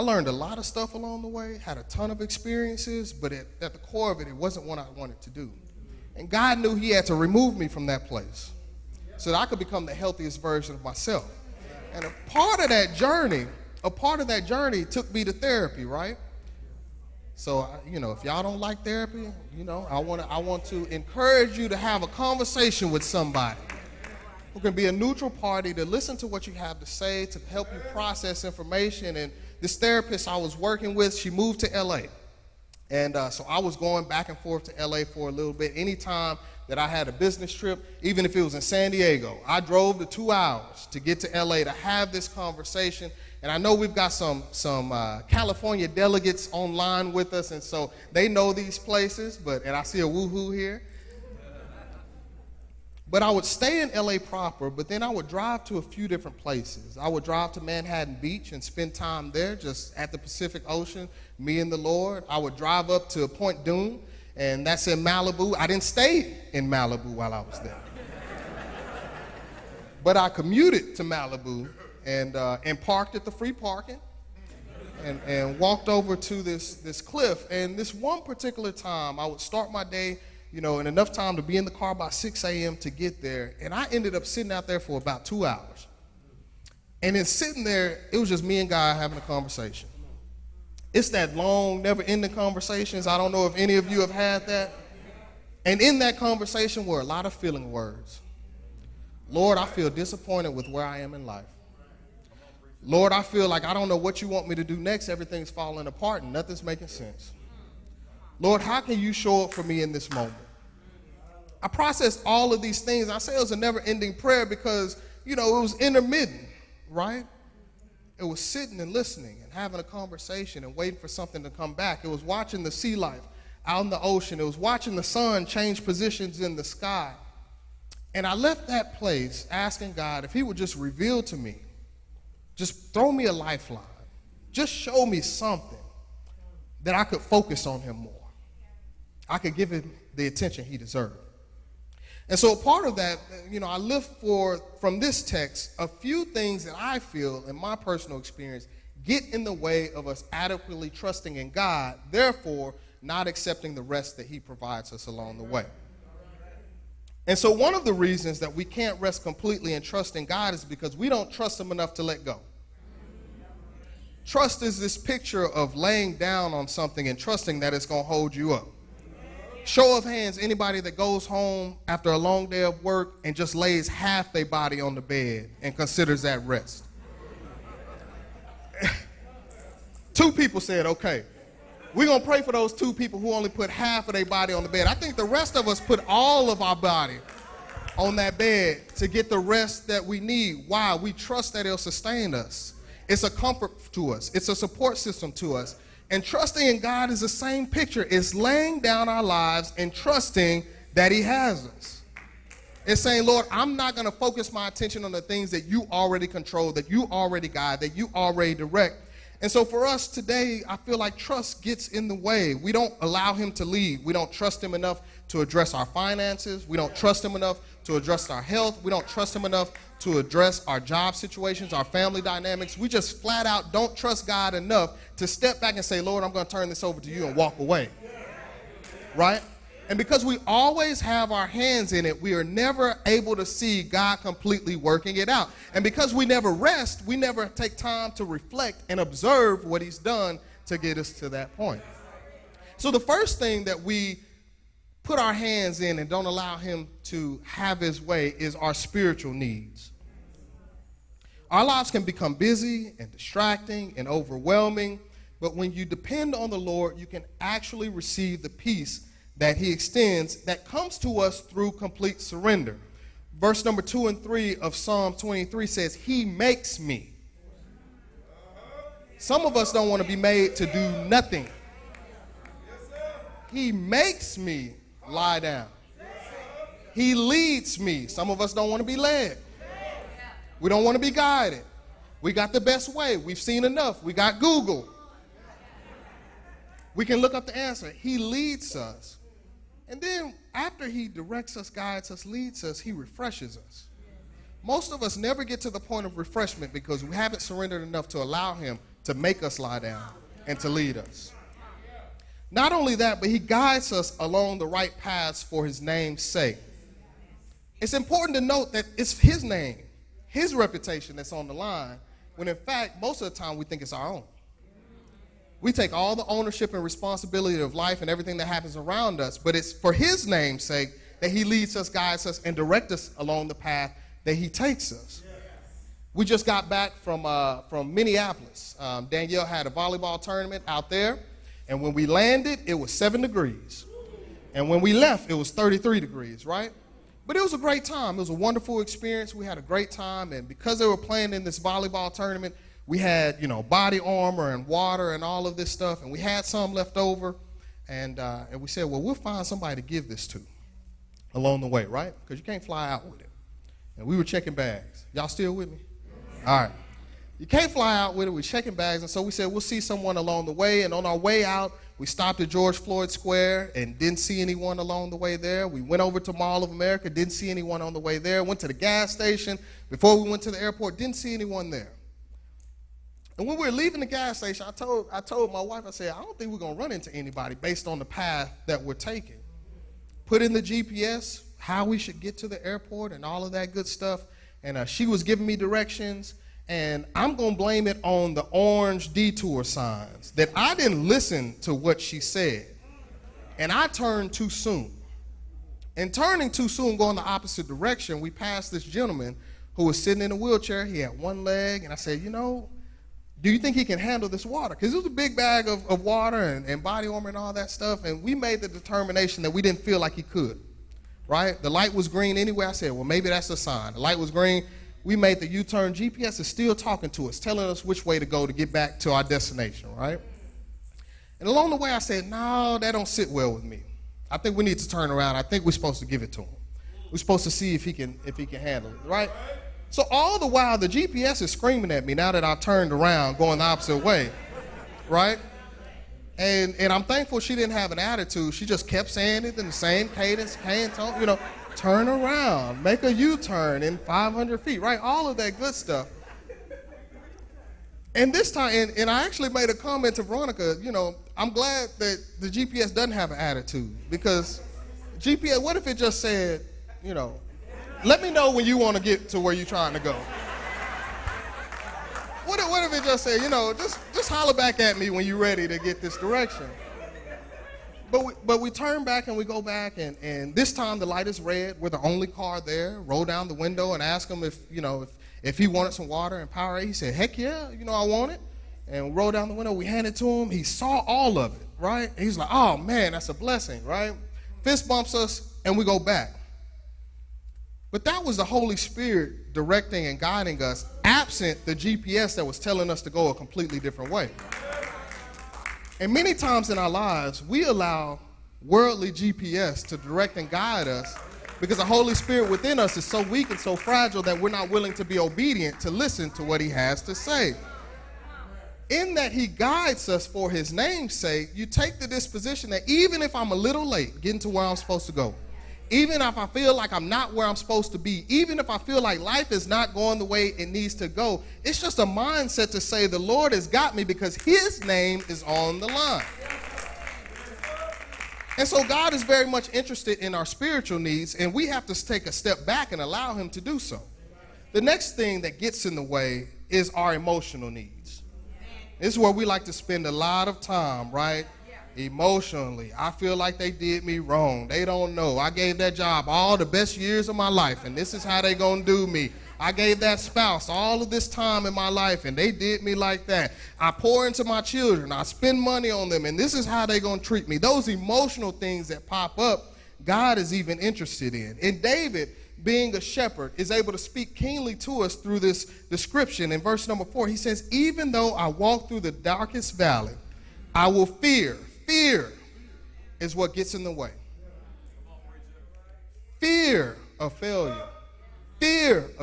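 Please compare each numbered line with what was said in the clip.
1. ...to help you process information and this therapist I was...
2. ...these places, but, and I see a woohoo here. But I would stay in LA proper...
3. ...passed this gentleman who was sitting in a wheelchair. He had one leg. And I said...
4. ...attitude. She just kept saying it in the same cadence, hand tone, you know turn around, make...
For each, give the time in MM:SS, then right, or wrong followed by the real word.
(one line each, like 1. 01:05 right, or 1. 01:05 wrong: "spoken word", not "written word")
1. 00:27 right
2. 00:48 right
3. 06:38 right
4. 07:17 right.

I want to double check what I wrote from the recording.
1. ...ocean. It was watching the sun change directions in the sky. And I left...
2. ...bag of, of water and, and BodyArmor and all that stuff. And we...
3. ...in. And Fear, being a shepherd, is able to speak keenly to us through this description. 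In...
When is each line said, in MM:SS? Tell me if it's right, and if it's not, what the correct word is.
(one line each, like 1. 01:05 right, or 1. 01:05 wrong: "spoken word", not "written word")
1. 02:04 wrong: "positions", not "directions"
2. 06:45 right
3. 09:21 wrong: "David", not "Fear".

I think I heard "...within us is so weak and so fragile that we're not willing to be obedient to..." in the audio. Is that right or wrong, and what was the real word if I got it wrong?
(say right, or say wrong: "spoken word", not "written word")
right.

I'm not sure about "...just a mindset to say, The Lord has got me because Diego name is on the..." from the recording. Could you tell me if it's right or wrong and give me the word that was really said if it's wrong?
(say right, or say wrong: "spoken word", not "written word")
wrong: "His", not "Diego".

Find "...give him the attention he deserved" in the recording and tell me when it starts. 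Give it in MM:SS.
02:19.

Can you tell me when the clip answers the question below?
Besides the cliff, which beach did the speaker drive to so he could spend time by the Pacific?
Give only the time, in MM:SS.
00:57.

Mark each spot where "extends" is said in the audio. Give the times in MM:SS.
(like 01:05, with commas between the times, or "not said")
04:19.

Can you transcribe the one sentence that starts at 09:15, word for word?
I spend money on them, and this is how they gonna treat me.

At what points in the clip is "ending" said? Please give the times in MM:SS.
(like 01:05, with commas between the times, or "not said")
01:32, 01:53.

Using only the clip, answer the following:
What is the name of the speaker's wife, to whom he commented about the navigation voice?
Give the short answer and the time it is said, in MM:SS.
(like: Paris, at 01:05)
Veronica, at 07:30.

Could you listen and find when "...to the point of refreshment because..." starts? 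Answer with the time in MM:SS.
04:55.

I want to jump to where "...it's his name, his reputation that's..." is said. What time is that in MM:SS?
05:08.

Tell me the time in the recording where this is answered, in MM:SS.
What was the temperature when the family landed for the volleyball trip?
05:32.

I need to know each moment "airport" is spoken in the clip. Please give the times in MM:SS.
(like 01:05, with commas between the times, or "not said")
06:10, 06:22.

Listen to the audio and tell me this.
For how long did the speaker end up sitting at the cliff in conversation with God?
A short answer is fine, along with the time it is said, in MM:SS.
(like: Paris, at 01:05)
2 hours, at 01:24.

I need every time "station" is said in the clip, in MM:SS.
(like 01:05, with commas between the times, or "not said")
06:09, 06:14.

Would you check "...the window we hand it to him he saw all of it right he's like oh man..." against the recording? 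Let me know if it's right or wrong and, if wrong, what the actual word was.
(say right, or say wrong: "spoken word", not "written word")
right.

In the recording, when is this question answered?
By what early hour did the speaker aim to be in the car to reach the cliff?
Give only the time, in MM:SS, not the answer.
01:22.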